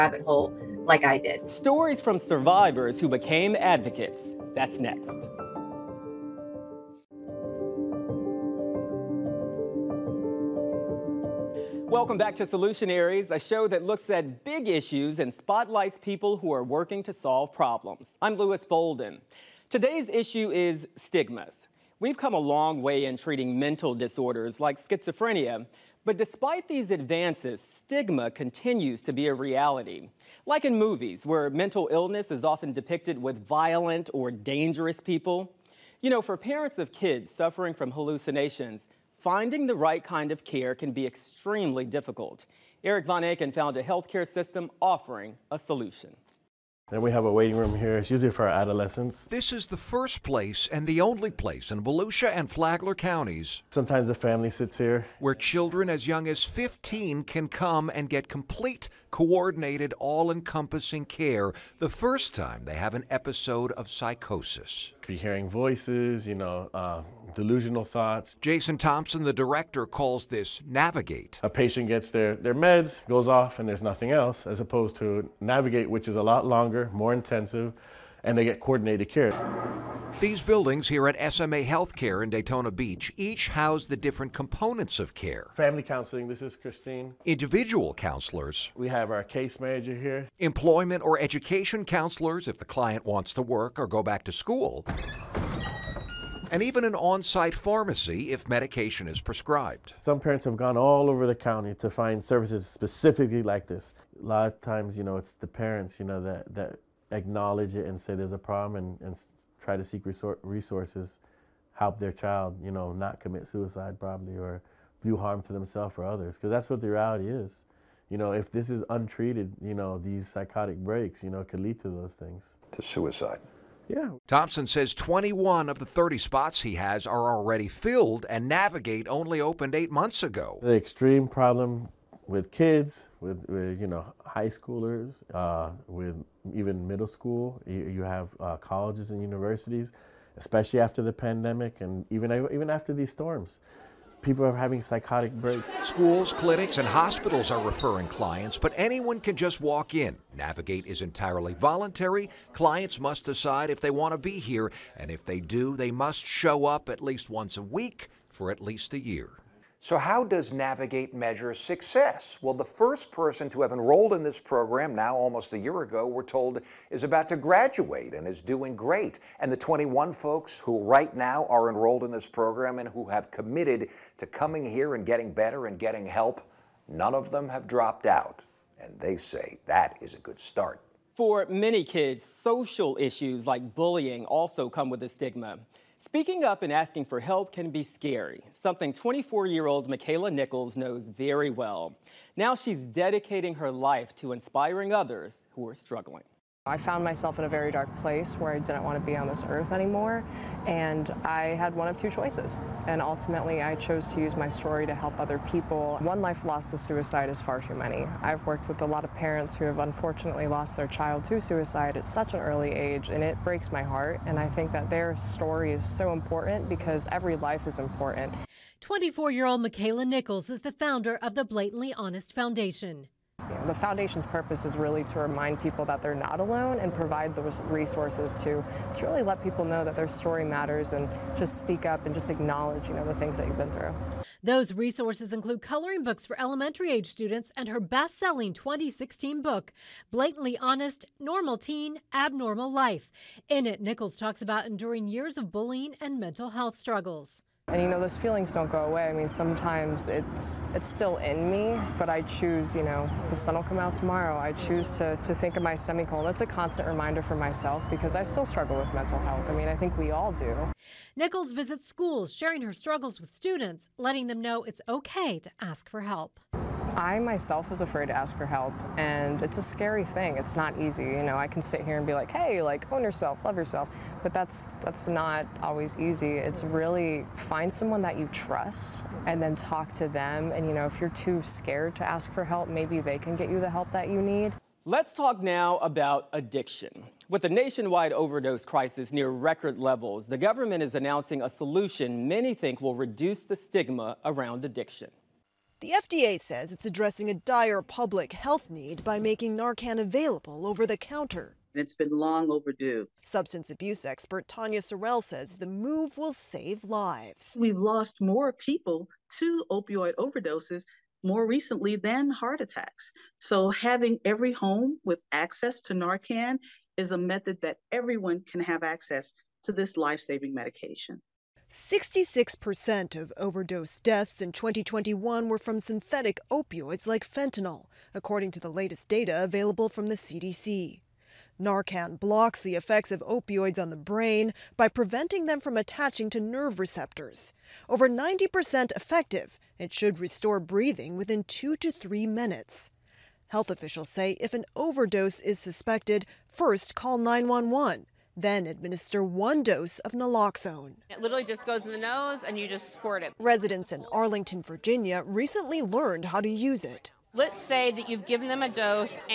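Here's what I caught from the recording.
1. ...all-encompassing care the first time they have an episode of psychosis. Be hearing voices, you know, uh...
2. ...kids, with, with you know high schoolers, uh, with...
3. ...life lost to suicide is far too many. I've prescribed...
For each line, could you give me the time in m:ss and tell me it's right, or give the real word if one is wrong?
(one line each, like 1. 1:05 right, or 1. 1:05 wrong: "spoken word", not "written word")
1. 0:59 right
2. 2:12 right
3. 3:26 wrong: "worked", not "prescribed".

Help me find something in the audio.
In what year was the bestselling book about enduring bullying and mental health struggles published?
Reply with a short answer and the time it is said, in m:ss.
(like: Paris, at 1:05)
2016, at 3:58.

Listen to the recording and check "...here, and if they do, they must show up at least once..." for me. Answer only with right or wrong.
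right.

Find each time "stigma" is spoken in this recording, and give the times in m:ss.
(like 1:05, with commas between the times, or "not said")
0:20, 0:27, 3:05, 4:53.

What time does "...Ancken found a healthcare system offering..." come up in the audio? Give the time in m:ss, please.
0:43.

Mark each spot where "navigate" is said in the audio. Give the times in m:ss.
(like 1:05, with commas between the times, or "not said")
1:10, 1:15, 2:08, 2:30, 2:40.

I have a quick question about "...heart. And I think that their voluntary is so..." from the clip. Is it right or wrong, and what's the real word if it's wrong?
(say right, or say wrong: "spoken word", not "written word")
wrong: "story", not "voluntary".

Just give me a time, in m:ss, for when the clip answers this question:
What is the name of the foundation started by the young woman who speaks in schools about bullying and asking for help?
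3:41.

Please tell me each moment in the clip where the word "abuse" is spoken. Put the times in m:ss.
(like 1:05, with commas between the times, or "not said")
5:03.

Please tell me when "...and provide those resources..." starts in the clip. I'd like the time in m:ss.
3:46.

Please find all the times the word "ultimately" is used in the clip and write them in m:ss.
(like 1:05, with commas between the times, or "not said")
3:23.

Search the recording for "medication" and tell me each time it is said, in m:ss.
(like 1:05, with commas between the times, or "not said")
1:38, 5:20.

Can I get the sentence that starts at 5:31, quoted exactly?
Narcan blocks the effects of opioids on the brain by preventing them from attaching to nerve receptors.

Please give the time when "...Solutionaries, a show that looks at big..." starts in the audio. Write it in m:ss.
0:12.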